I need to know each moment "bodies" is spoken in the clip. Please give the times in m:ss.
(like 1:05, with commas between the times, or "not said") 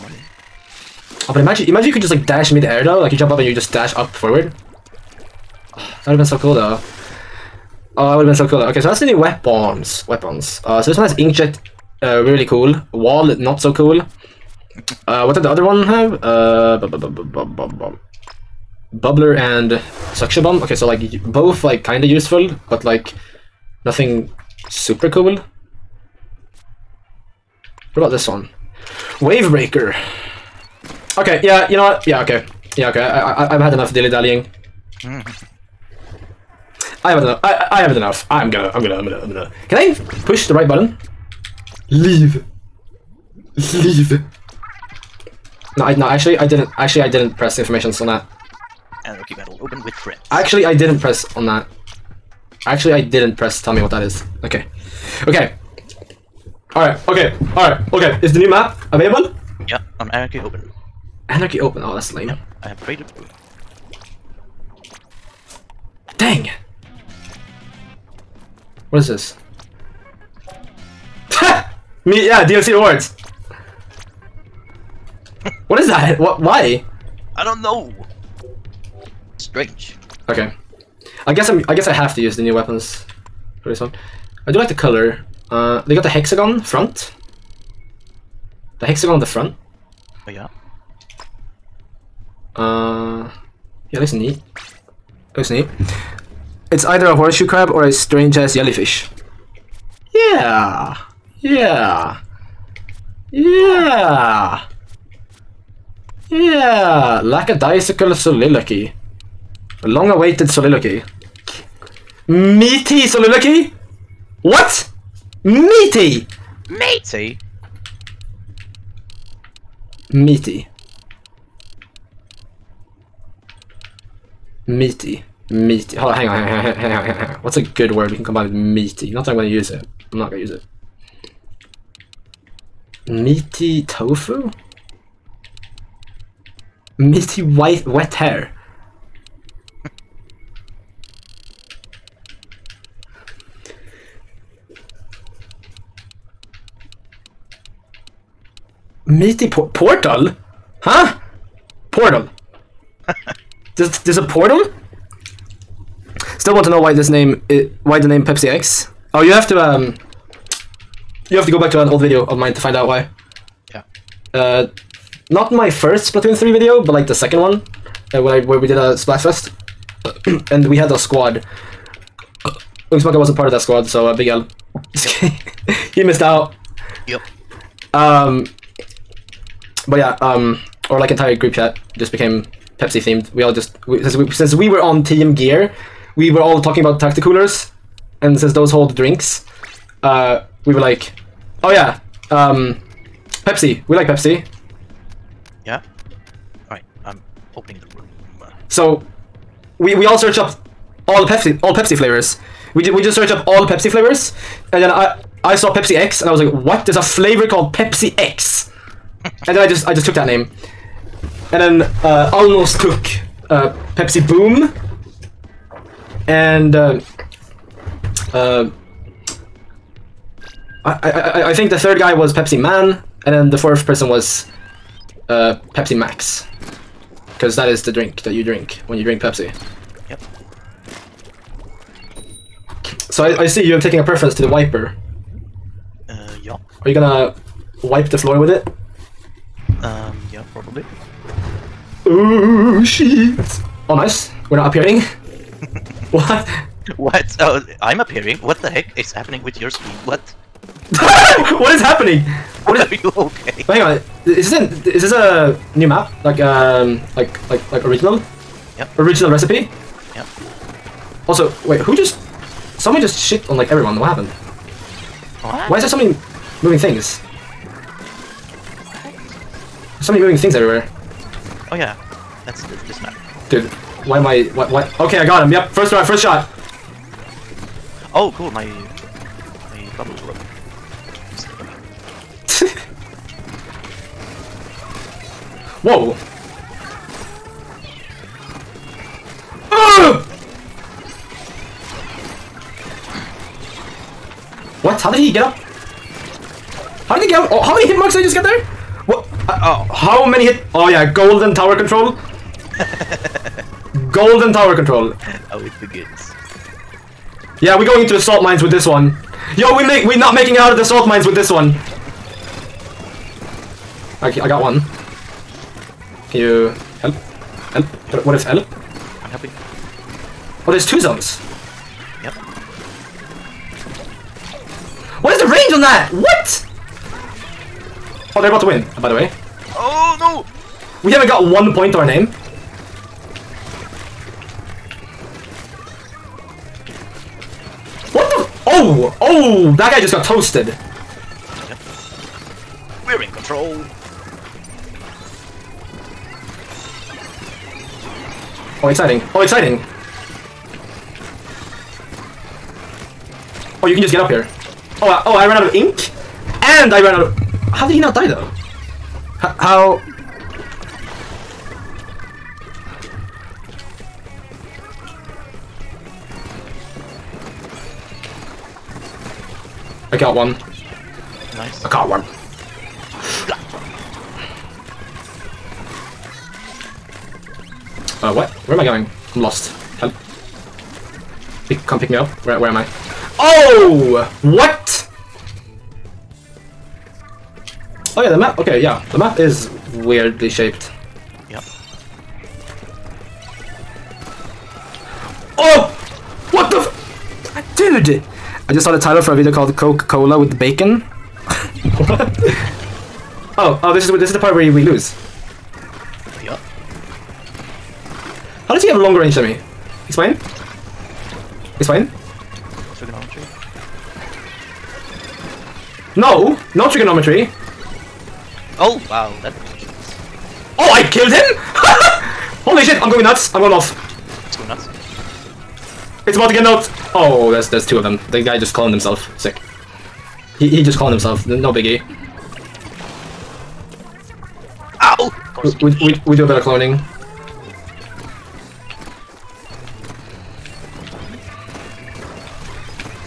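not said.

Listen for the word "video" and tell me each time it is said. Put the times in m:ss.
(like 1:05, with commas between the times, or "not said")
2:42, 2:46, 6:39.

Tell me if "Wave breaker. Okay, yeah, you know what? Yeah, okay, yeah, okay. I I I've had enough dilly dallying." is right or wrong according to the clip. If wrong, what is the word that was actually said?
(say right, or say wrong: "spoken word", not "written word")
right.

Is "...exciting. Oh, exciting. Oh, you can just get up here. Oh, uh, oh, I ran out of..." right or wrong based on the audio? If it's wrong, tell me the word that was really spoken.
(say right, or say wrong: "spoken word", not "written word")
right.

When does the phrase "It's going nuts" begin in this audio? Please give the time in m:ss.
7:04.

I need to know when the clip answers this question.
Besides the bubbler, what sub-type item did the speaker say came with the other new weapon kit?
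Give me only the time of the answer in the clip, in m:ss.
0:20.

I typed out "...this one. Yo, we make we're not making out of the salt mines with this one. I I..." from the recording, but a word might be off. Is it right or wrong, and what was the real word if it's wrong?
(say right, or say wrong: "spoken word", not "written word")
right.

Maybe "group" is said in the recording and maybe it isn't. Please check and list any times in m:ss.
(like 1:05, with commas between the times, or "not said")
3:01.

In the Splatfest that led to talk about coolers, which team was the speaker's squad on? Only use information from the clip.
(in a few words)
Team Gear.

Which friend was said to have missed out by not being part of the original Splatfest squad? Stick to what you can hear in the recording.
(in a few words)
Ugnsmacka.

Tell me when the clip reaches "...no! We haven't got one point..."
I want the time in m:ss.
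5:30.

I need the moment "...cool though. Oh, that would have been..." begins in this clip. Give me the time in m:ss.
0:06.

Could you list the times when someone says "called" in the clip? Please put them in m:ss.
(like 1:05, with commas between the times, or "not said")
3:27, 6:39.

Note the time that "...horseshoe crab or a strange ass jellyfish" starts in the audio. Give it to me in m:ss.
1:37.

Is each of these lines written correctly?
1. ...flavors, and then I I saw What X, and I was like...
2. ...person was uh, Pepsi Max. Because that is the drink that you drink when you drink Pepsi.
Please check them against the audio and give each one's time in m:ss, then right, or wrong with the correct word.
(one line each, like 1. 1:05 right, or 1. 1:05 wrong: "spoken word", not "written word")
1. 3:23 wrong: "Pepsi", not "What"
2. 3:43 right.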